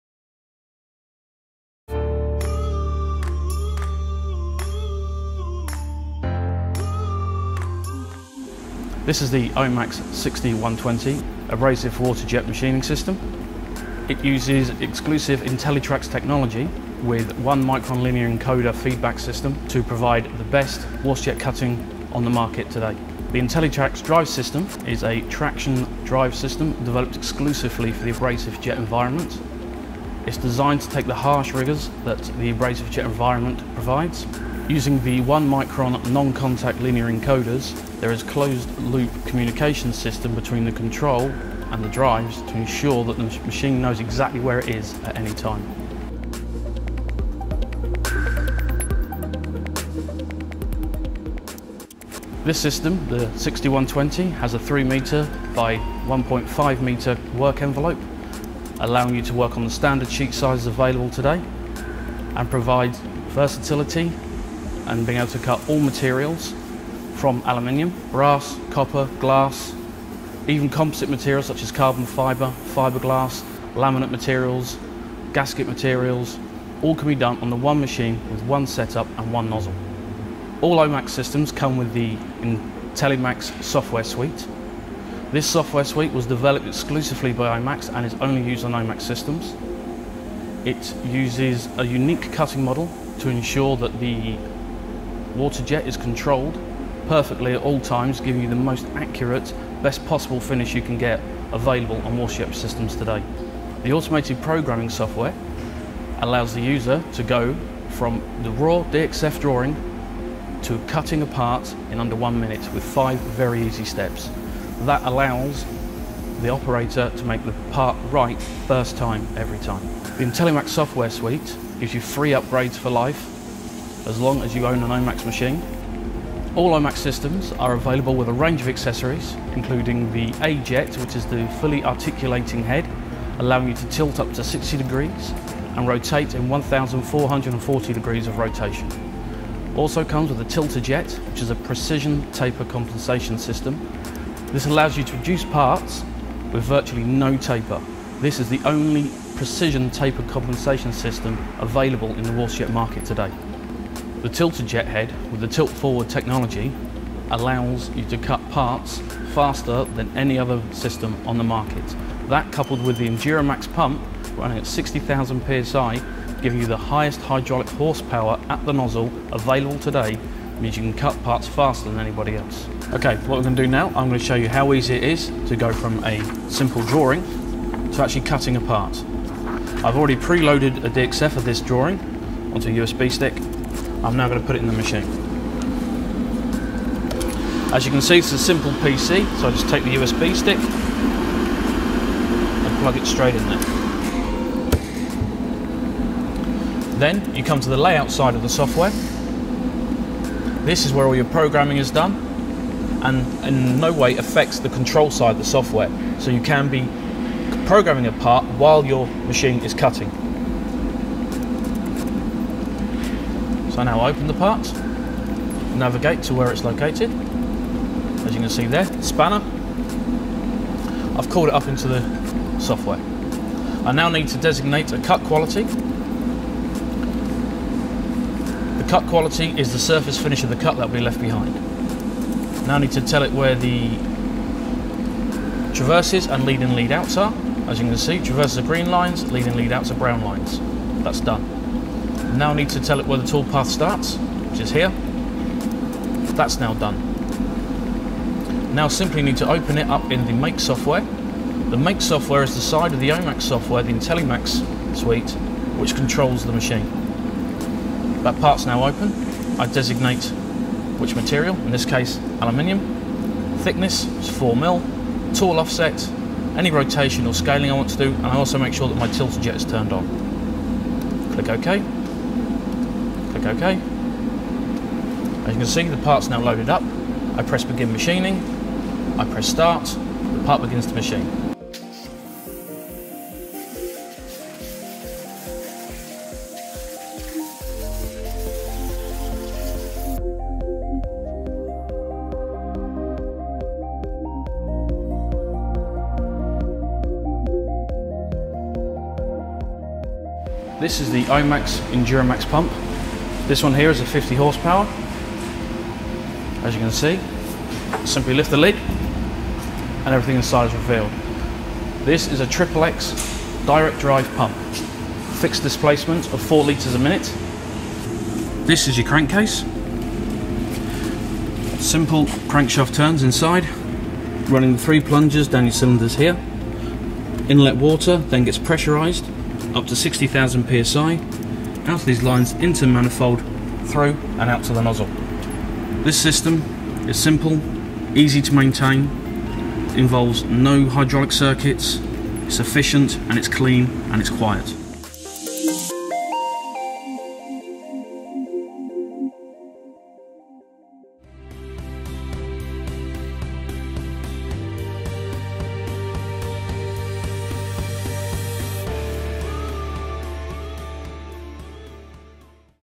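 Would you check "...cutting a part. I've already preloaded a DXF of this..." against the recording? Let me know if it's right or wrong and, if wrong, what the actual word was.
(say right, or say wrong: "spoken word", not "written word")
right.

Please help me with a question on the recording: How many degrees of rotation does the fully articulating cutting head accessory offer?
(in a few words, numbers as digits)
1,440.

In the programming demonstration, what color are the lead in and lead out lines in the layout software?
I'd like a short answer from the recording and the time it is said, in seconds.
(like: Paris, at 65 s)
Brown, at 239 s.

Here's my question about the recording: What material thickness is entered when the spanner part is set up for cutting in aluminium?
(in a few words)
4 mil.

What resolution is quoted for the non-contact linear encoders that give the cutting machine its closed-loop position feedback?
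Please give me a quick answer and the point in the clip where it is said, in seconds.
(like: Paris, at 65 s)
1 micron, at 35 s.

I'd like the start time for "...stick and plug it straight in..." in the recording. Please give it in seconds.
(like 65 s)
190 s.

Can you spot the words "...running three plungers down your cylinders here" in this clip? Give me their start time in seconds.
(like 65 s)
324 s.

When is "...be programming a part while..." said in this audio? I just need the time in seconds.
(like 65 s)
206 s.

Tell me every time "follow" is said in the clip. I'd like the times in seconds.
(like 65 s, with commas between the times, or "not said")
not said.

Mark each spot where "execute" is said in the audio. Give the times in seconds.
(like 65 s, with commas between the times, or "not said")
not said.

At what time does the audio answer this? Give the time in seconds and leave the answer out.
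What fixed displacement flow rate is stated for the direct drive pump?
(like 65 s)
316 s.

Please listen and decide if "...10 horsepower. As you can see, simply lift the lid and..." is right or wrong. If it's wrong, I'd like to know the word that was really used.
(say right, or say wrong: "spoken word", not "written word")
wrong: "50", not "10".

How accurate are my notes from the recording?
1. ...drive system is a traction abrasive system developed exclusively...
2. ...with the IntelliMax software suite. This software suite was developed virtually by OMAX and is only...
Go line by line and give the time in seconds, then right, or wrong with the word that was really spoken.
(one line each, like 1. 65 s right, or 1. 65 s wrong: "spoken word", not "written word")
1. 24 s wrong: "drive", not "abrasive"
2. 81 s wrong: "exclusively", not "virtually".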